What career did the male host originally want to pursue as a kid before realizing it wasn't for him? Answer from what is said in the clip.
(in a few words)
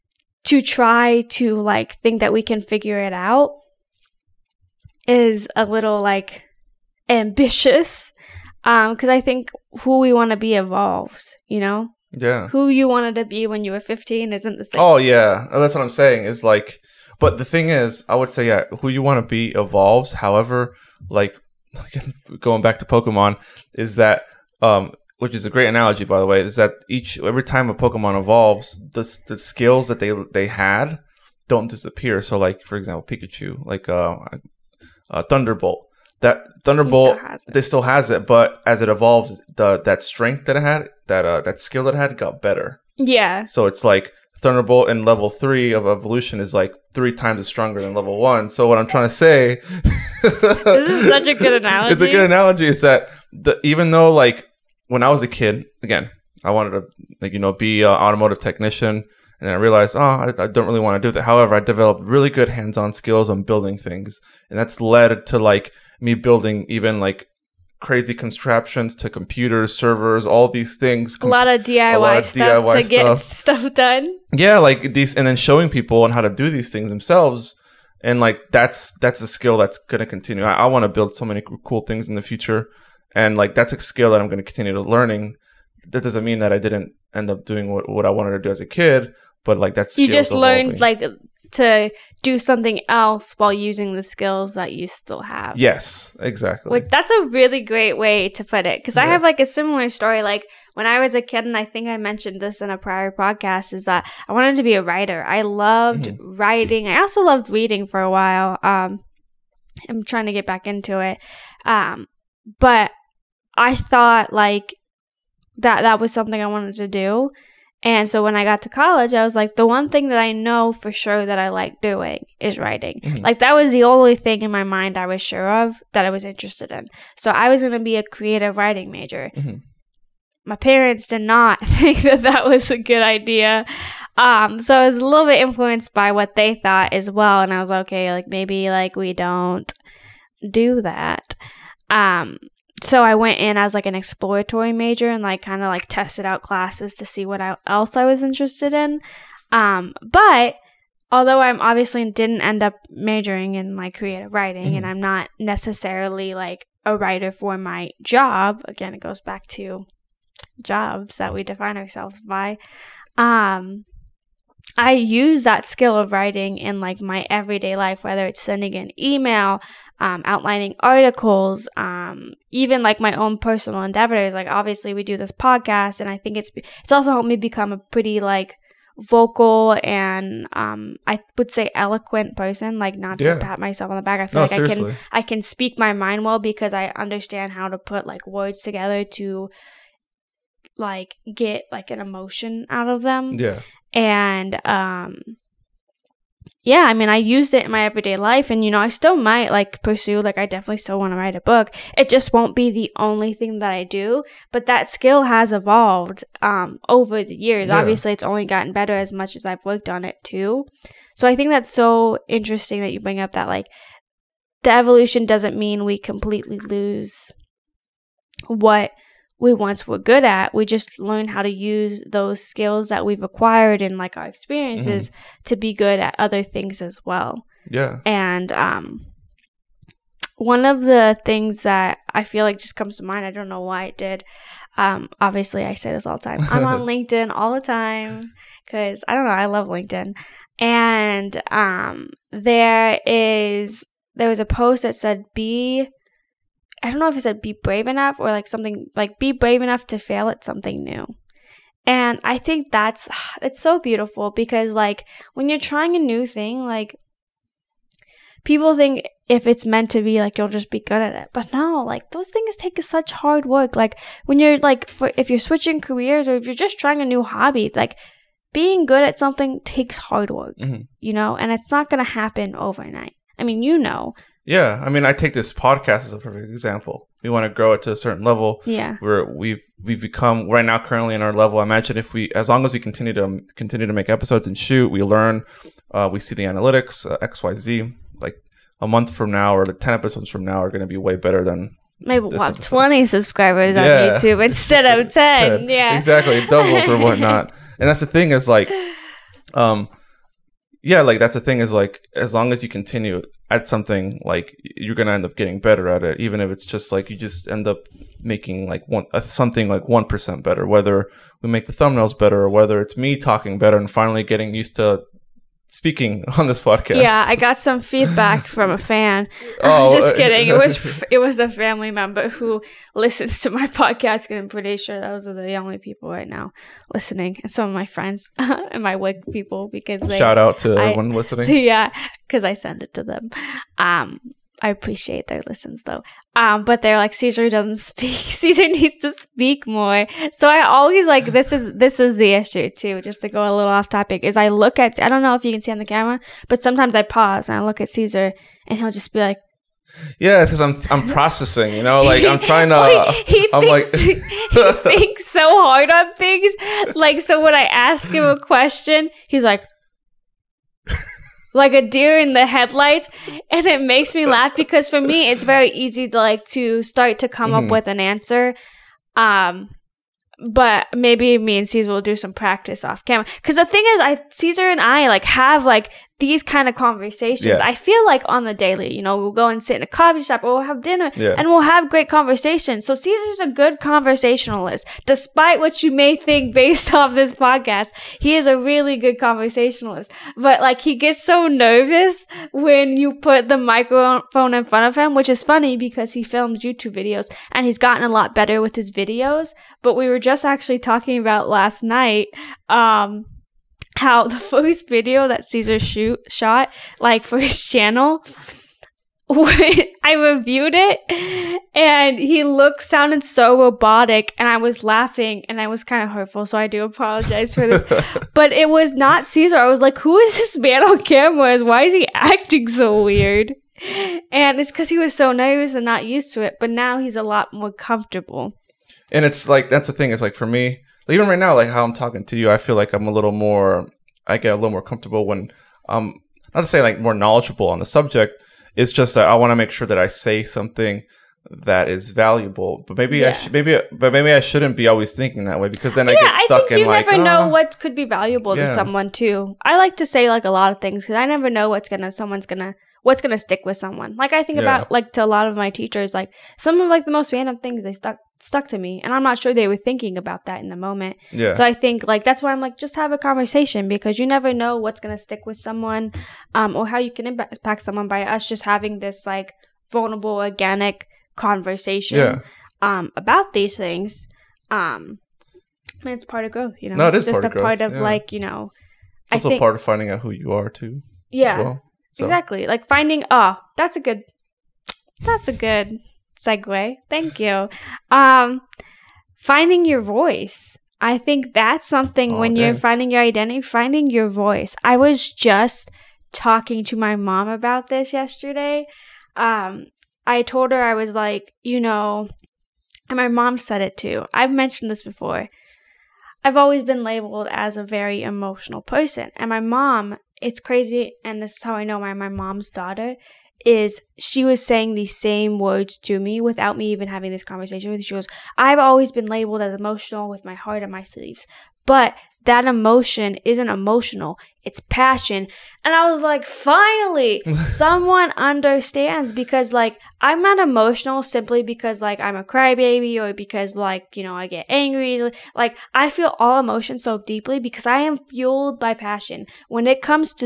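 Automotive technician.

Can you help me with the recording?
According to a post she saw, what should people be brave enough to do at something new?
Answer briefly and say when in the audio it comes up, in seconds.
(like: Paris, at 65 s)
Fail, at 249 s.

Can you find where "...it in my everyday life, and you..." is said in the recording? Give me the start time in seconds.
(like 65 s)
197 s.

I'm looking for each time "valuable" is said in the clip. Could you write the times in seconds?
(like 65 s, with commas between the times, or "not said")
442 s, 448 s.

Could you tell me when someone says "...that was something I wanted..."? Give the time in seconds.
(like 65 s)
115 s.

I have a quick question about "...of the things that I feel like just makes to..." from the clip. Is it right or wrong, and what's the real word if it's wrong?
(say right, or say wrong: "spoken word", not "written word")
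wrong: "comes", not "makes".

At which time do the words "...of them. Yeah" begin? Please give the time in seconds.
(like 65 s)
192 s.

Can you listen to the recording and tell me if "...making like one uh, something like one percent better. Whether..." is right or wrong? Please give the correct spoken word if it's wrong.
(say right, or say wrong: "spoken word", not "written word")
right.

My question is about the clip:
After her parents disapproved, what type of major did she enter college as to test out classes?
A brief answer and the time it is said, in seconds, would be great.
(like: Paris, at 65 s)
Exploratory major, at 143 s.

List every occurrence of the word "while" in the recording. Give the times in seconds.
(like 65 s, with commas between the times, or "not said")
93 s, 108 s.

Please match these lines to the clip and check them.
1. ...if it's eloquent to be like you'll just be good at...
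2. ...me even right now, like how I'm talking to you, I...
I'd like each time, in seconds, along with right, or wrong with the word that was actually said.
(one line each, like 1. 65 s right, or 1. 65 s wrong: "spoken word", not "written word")
1. 259 s wrong: "meant", not "eloquent"
2. 430 s right.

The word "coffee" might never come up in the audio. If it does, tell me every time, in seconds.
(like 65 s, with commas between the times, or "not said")
379 s.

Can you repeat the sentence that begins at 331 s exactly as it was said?
Yeah, because I send it to them.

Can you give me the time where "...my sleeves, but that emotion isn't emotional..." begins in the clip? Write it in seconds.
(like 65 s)
520 s.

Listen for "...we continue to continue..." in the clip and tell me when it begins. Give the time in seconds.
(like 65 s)
282 s.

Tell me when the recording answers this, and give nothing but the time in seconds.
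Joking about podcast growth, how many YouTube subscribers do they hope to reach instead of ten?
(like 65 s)
292 s.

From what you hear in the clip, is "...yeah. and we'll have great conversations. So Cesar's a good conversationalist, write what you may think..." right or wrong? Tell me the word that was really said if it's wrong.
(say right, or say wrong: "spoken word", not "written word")
wrong: "despite", not "write".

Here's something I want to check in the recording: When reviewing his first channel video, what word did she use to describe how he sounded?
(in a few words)
Robotic.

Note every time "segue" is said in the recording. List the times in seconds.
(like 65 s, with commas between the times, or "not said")
486 s.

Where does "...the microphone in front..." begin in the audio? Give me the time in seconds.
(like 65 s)
393 s.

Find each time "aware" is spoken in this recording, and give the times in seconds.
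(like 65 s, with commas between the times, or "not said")
not said.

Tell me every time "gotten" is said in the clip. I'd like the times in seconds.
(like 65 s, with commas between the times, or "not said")
208 s, 397 s.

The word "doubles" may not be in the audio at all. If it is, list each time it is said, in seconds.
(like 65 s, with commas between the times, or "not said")
296 s.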